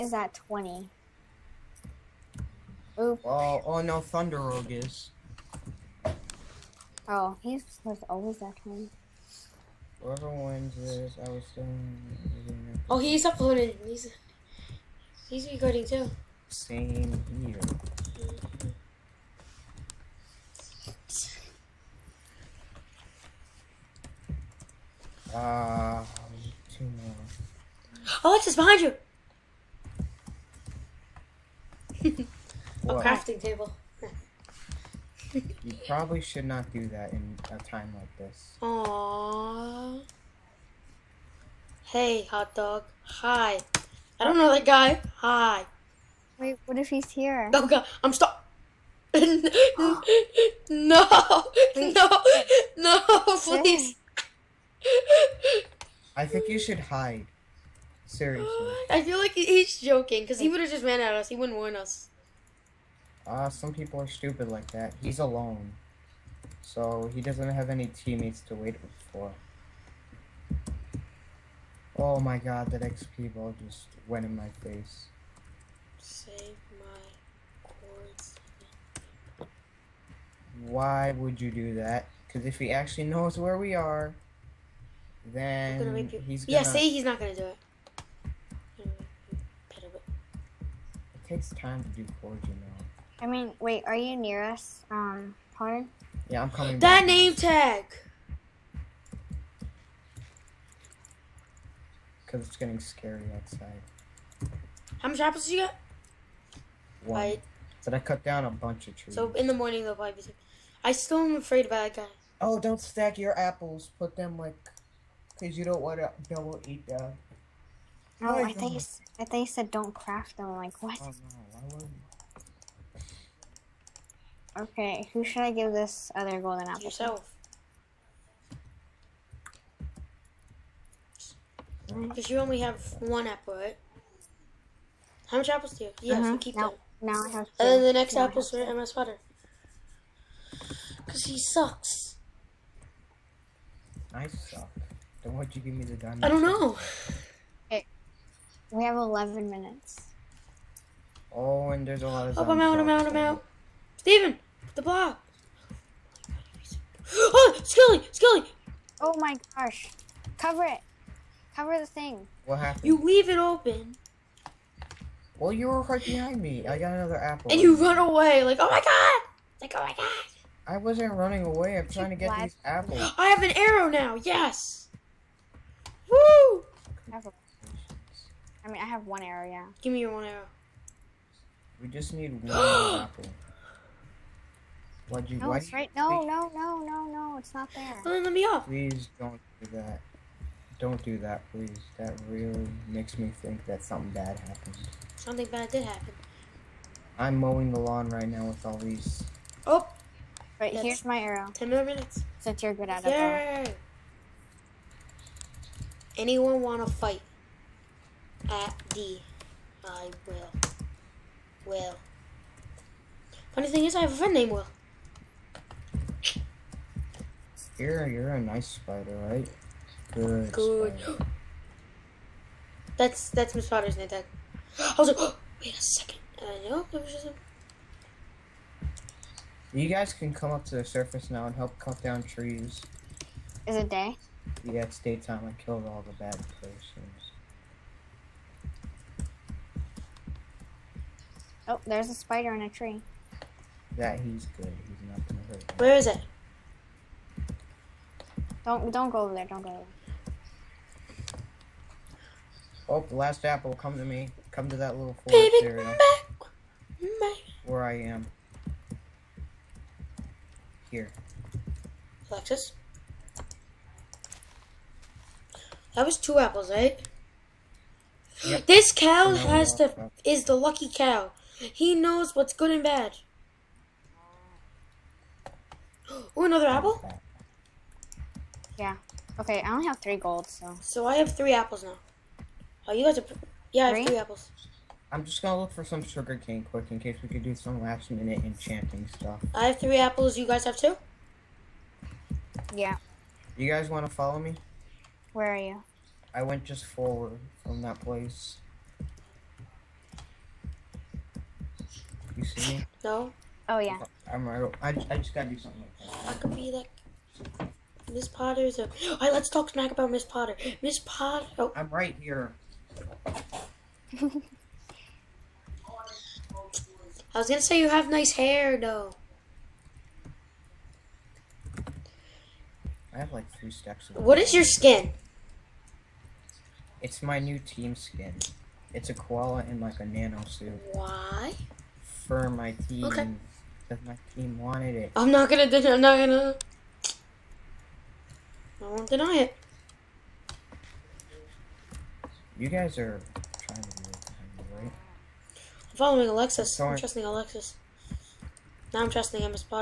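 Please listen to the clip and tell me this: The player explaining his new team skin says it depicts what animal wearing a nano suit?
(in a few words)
koala.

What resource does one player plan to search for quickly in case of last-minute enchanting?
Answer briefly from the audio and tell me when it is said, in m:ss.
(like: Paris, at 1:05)
sugar cane, at 4:46.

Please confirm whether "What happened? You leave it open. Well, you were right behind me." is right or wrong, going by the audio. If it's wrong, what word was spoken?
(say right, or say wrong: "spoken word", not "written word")
right.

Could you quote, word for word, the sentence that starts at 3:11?
That really makes me think that something bad happened.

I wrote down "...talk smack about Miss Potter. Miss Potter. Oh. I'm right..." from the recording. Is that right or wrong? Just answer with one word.
right.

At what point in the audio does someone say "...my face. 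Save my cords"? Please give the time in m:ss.
1:14.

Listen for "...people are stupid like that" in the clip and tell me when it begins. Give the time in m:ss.
1:03.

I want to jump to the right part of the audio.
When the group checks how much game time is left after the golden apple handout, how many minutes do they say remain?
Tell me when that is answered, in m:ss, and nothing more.
2:28.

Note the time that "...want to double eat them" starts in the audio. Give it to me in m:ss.
1:55.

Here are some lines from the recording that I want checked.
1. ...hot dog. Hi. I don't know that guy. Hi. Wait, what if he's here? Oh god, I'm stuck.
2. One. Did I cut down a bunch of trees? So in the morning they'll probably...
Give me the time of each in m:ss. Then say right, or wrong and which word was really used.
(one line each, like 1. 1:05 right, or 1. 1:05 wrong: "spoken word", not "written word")
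1. 0:42 right
2. 1:47 right.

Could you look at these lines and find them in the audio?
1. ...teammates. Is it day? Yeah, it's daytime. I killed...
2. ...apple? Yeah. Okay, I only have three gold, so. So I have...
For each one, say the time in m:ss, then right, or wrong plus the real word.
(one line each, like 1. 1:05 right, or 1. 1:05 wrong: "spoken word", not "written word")
1. 3:52 wrong: "trees", not "teammates"
2. 4:36 right.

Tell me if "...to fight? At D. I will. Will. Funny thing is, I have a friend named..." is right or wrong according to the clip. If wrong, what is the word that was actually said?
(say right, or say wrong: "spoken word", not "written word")
right.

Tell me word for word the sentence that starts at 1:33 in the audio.
I mean, wait, are you near us, um, Connor?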